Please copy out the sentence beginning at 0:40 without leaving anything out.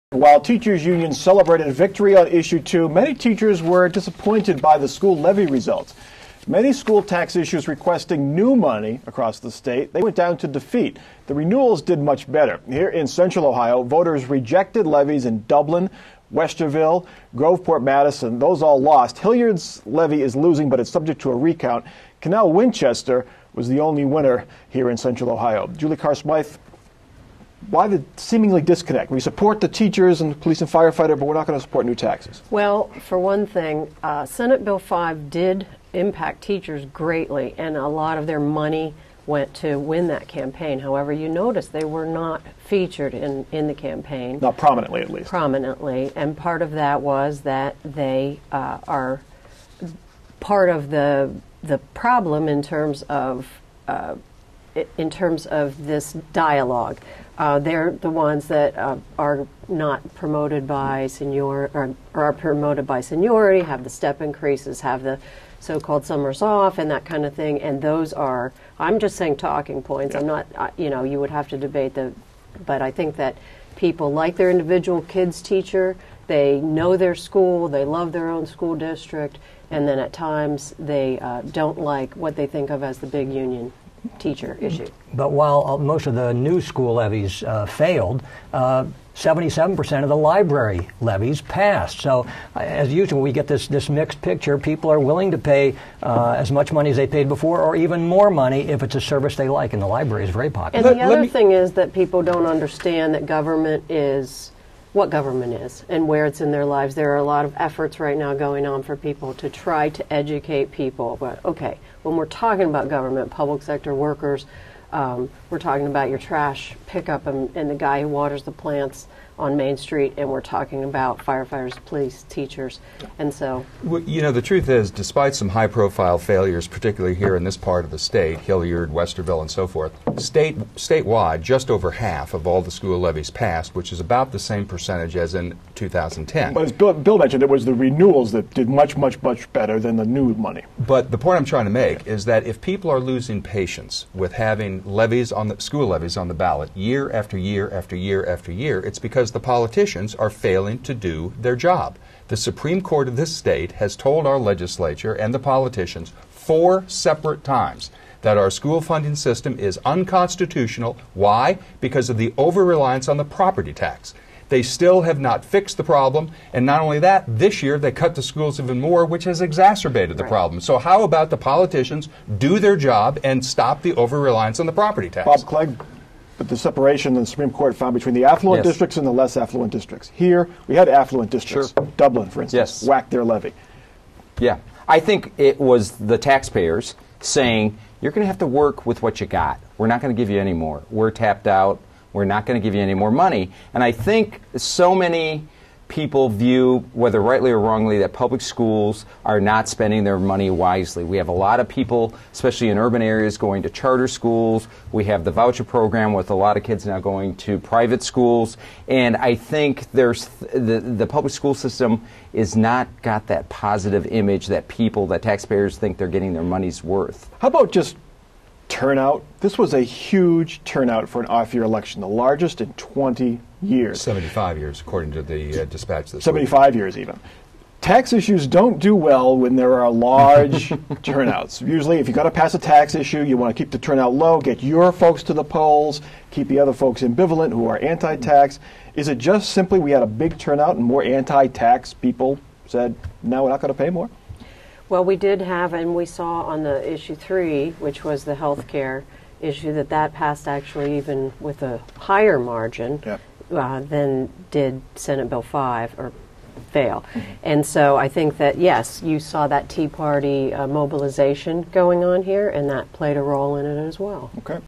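However, you notice they were not featured in, in the campaign.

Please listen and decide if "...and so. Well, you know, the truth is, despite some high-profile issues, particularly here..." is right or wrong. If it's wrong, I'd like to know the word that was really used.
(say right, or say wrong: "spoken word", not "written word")
wrong: "failures", not "issues".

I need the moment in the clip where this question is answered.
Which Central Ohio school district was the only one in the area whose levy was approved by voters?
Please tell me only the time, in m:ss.
0:22.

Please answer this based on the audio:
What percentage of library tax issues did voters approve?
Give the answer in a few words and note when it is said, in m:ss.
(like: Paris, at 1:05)
77%, at 1:28.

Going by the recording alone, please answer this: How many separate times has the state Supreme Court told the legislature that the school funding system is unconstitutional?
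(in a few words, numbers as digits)
4.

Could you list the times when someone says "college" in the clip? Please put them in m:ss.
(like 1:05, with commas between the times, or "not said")
not said.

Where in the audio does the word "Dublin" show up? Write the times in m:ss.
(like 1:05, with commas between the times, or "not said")
0:15, 3:01.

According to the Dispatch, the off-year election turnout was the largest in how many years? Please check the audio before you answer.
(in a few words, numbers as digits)
75.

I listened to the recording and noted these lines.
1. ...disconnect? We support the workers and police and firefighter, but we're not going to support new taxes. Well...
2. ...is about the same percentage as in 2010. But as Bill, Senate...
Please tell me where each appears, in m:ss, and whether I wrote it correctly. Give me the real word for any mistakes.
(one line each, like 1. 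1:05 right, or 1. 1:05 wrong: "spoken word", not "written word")
1. 0:28 wrong: "teachers", not "workers"
2. 2:13 wrong: "Bill", not "Senate".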